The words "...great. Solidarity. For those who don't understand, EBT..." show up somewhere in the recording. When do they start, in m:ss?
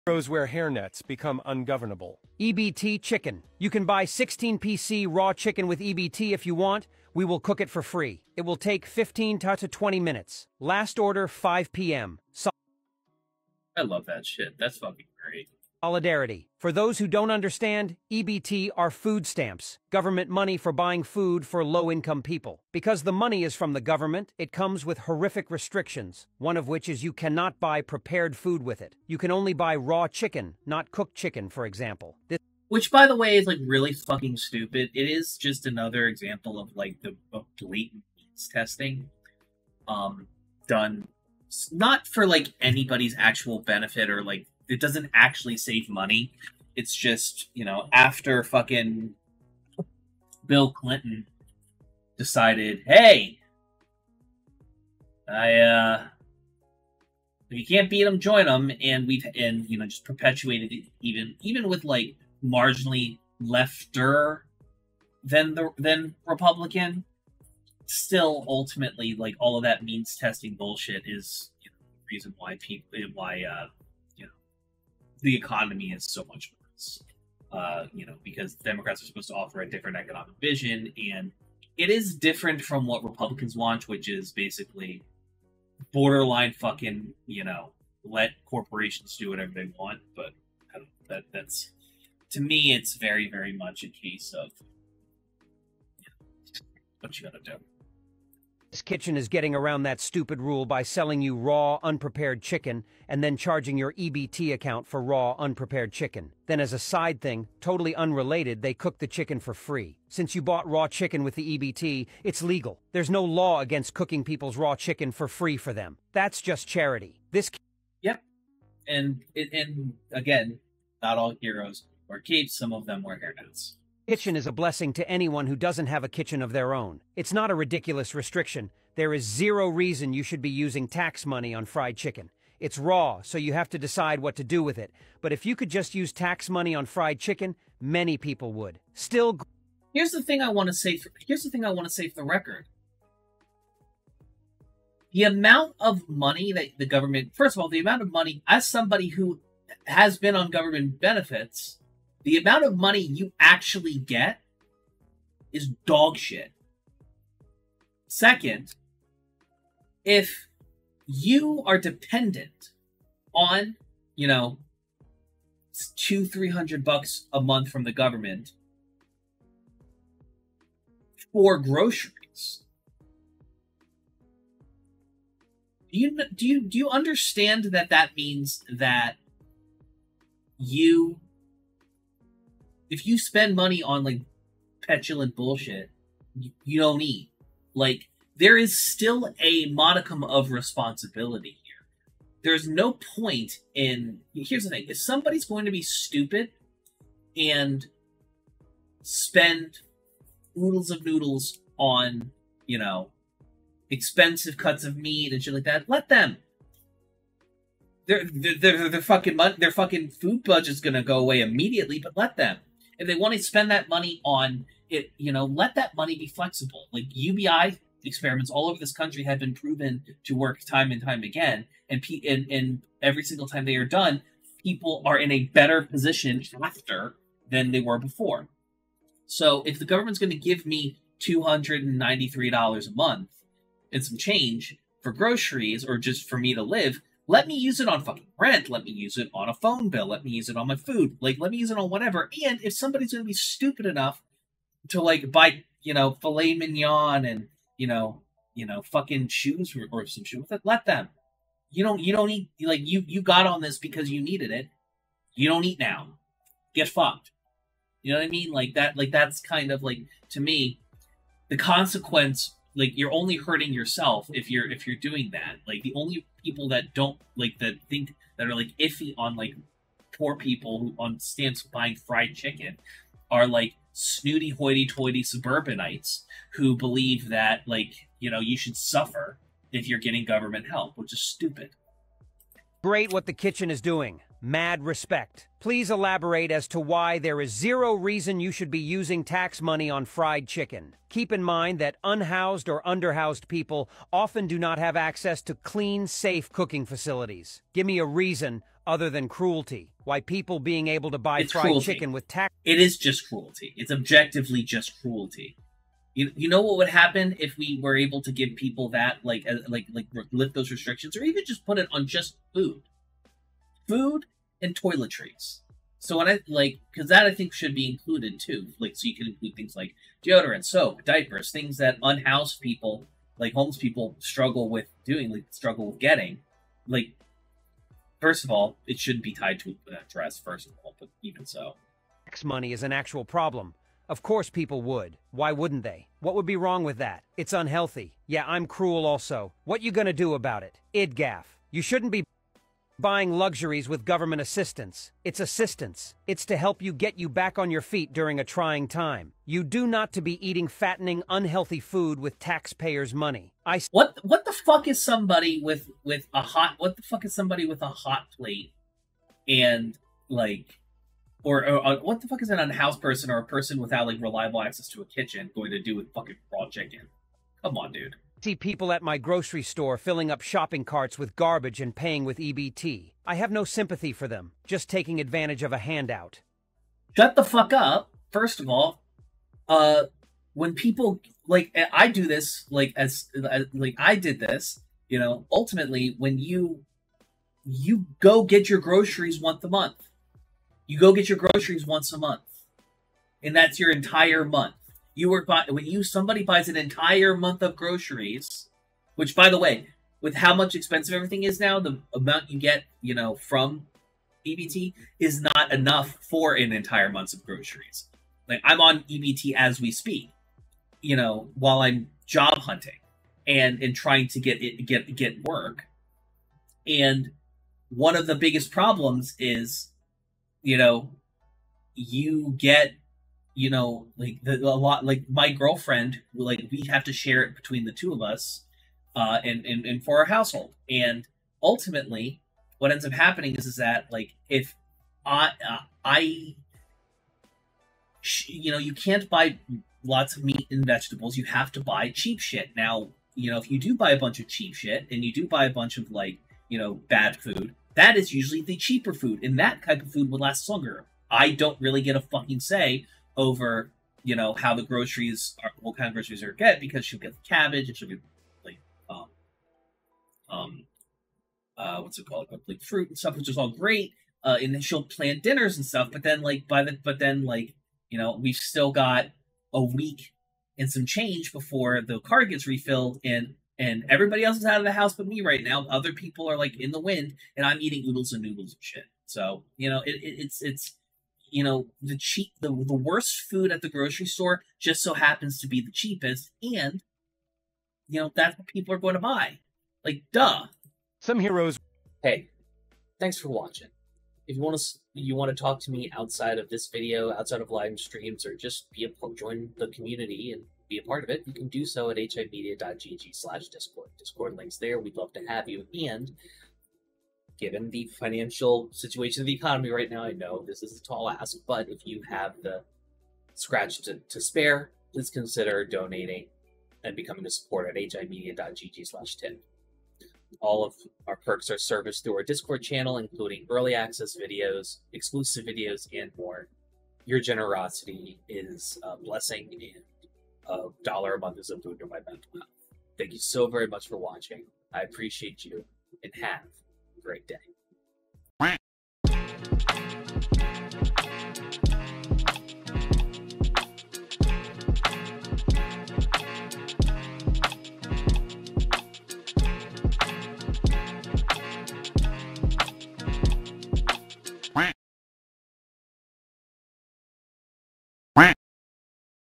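0:15.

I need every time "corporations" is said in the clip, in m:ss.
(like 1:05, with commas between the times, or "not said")
1:28.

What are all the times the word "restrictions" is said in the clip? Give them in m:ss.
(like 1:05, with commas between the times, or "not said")
0:25, 2:08, 5:10.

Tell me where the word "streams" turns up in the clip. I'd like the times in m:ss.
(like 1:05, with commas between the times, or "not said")
8:17.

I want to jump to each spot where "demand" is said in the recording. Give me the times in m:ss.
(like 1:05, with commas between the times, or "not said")
not said.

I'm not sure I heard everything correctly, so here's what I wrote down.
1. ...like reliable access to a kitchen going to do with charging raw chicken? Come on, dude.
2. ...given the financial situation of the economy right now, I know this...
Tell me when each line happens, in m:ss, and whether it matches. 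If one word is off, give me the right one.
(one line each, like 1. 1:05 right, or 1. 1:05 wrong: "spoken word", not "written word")
1. 6:04 wrong: "fucking", not "charging"
2. 8:27 right.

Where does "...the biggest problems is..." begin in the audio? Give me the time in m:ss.
6:58.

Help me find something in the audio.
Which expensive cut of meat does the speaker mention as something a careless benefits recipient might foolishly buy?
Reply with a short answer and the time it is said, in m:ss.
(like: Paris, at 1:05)
filet mignon, at 4:06.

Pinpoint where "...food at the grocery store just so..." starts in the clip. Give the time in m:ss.
8:03.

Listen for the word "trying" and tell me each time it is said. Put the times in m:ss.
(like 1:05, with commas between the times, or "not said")
5:48, 6:53.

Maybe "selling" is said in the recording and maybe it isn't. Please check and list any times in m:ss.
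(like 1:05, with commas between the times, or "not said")
1:40.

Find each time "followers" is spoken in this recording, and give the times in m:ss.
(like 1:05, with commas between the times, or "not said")
not said.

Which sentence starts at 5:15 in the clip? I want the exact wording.
So when I like, because that I think should be included too.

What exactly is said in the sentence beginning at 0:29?
You can only buy raw chicken, not cooked chicken, for example.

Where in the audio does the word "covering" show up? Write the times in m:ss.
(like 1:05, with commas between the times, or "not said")
not said.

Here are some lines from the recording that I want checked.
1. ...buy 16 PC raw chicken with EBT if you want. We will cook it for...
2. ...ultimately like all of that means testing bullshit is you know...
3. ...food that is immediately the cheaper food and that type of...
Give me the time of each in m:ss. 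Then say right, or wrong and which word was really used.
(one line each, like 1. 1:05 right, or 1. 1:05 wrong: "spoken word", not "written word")
1. 0:03 right
2. 1:08 right
3. 7:27 wrong: "usually", not "immediately".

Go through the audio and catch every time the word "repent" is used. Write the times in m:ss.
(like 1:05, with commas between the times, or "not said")
not said.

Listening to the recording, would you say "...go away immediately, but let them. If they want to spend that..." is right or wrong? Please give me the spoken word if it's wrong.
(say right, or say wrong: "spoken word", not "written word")
right.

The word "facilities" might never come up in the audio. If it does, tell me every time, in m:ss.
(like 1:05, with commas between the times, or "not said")
4:56.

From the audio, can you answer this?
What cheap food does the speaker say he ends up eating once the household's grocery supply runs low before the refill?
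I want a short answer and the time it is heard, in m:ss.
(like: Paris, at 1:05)
oodles and noodles, at 7:58.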